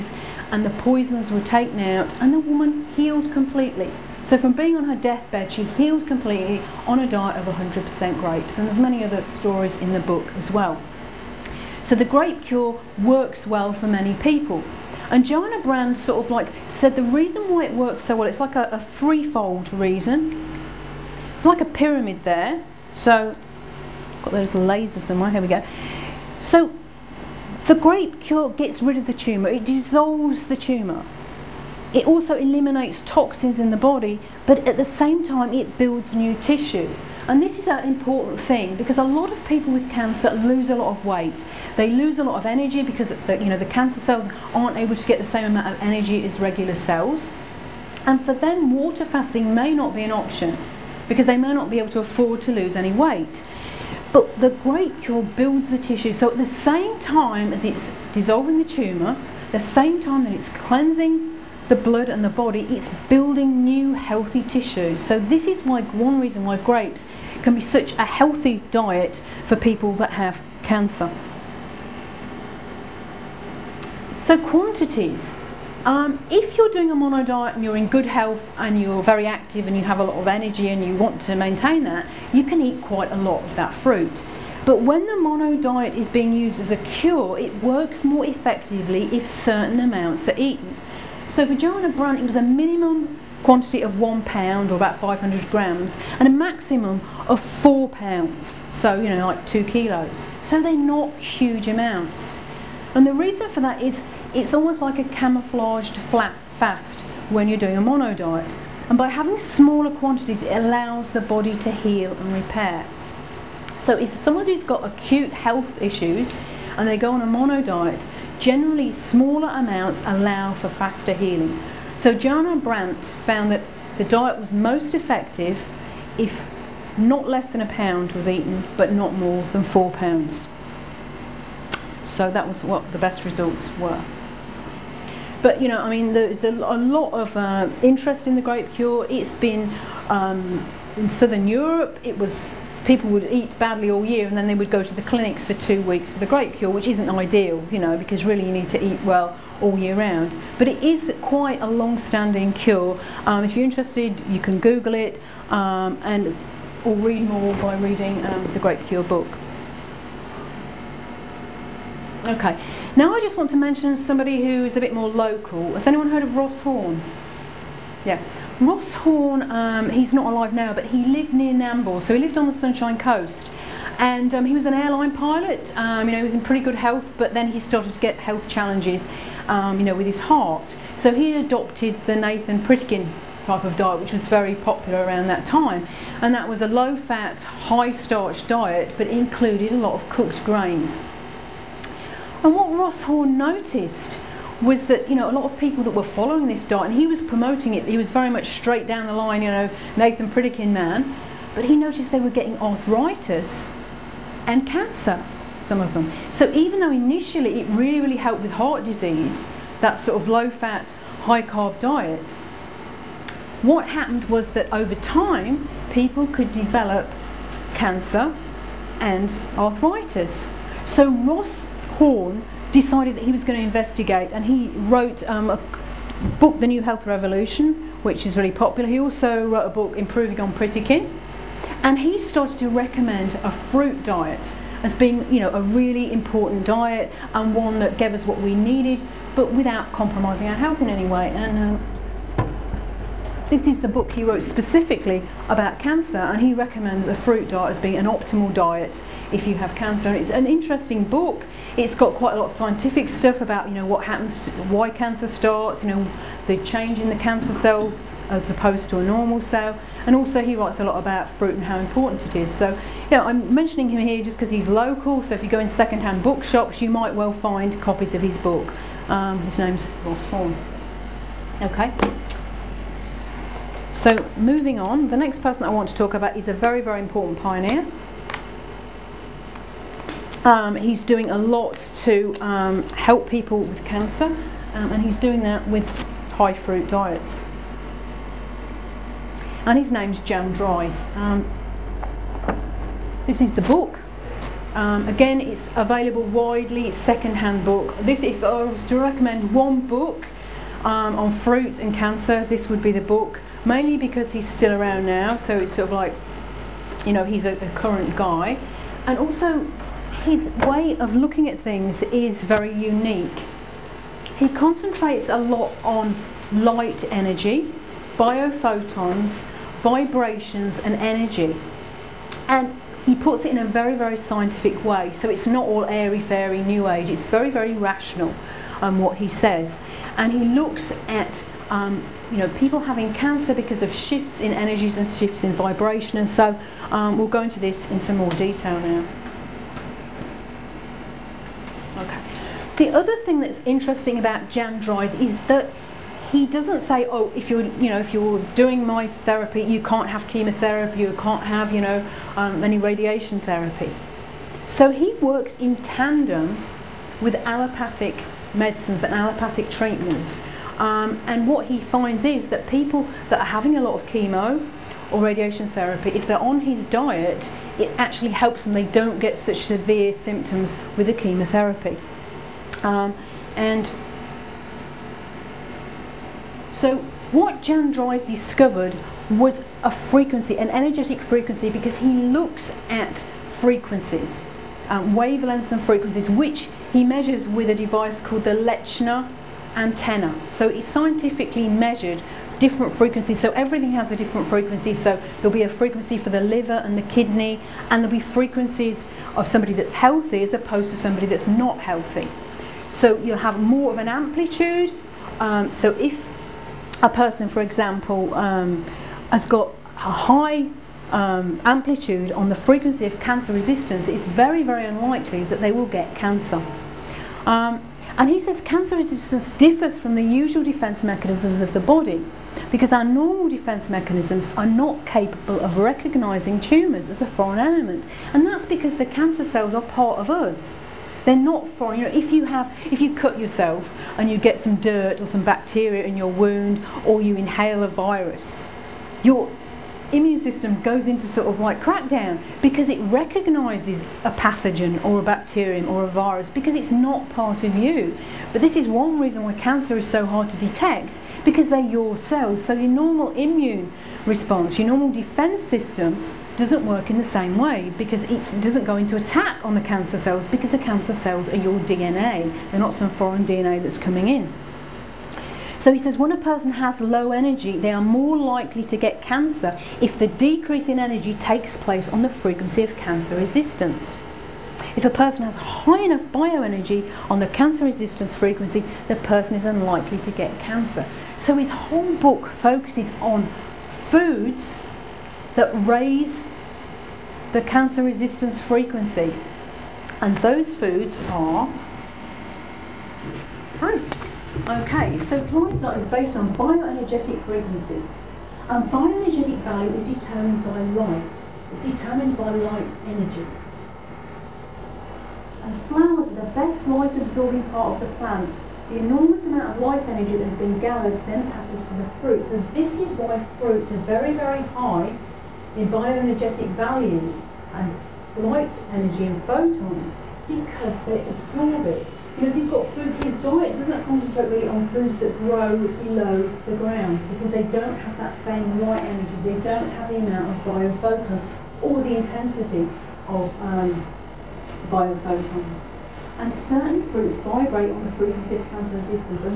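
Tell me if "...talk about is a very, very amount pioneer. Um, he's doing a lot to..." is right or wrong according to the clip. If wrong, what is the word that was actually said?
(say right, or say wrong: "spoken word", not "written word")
wrong: "important", not "amount".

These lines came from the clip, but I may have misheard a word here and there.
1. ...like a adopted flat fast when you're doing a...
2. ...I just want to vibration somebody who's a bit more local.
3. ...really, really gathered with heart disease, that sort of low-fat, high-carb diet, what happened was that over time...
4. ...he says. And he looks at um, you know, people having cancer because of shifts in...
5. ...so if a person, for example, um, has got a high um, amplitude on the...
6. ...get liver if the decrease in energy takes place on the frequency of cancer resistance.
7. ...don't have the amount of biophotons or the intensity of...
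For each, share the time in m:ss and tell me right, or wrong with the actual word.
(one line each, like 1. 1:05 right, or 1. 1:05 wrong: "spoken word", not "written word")
1. 1:44 wrong: "camouflaged", not "adopted"
2. 2:43 wrong: "mention", not "vibration"
3. 3:27 wrong: "helped", not "gathered"
4. 5:29 right
5. 6:45 right
6. 7:48 wrong: "cancer", not "liver"
7. 8:49 right.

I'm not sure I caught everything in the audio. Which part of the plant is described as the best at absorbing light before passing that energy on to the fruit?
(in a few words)
Flowers.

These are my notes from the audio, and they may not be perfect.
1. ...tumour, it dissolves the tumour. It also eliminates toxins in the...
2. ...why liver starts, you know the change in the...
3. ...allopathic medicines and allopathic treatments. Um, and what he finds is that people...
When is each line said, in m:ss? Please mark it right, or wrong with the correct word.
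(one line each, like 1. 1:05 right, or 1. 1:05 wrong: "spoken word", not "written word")
1. 0:29 right
2. 4:14 wrong: "cancer", not "liver"
3. 5:57 right.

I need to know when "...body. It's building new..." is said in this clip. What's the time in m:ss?
1:02.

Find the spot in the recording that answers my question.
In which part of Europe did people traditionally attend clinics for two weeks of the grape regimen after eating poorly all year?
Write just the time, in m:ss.
2:21.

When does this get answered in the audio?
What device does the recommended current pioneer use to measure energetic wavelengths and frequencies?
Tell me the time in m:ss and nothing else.
6:28.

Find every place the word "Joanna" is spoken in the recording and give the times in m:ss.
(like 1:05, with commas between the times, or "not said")
0:15, 1:31, 2:02.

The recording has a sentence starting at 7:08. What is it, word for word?
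And that's because the cancer cells are part of us.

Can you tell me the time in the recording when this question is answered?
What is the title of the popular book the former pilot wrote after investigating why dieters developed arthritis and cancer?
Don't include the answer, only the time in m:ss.
3:46.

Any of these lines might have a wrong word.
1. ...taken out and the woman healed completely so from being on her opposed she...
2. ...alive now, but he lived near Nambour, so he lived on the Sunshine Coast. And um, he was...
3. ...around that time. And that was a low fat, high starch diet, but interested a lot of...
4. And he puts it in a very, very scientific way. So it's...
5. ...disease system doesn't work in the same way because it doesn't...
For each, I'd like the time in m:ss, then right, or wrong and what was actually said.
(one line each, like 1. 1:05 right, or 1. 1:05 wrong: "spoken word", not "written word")
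1. 0:01 wrong: "deathbed", not "opposed"
2. 2:50 right
3. 3:05 wrong: "included", not "interested"
4. 5:22 right
5. 7:35 wrong: "defense", not "disease".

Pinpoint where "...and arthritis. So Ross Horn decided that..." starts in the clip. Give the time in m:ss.
3:38.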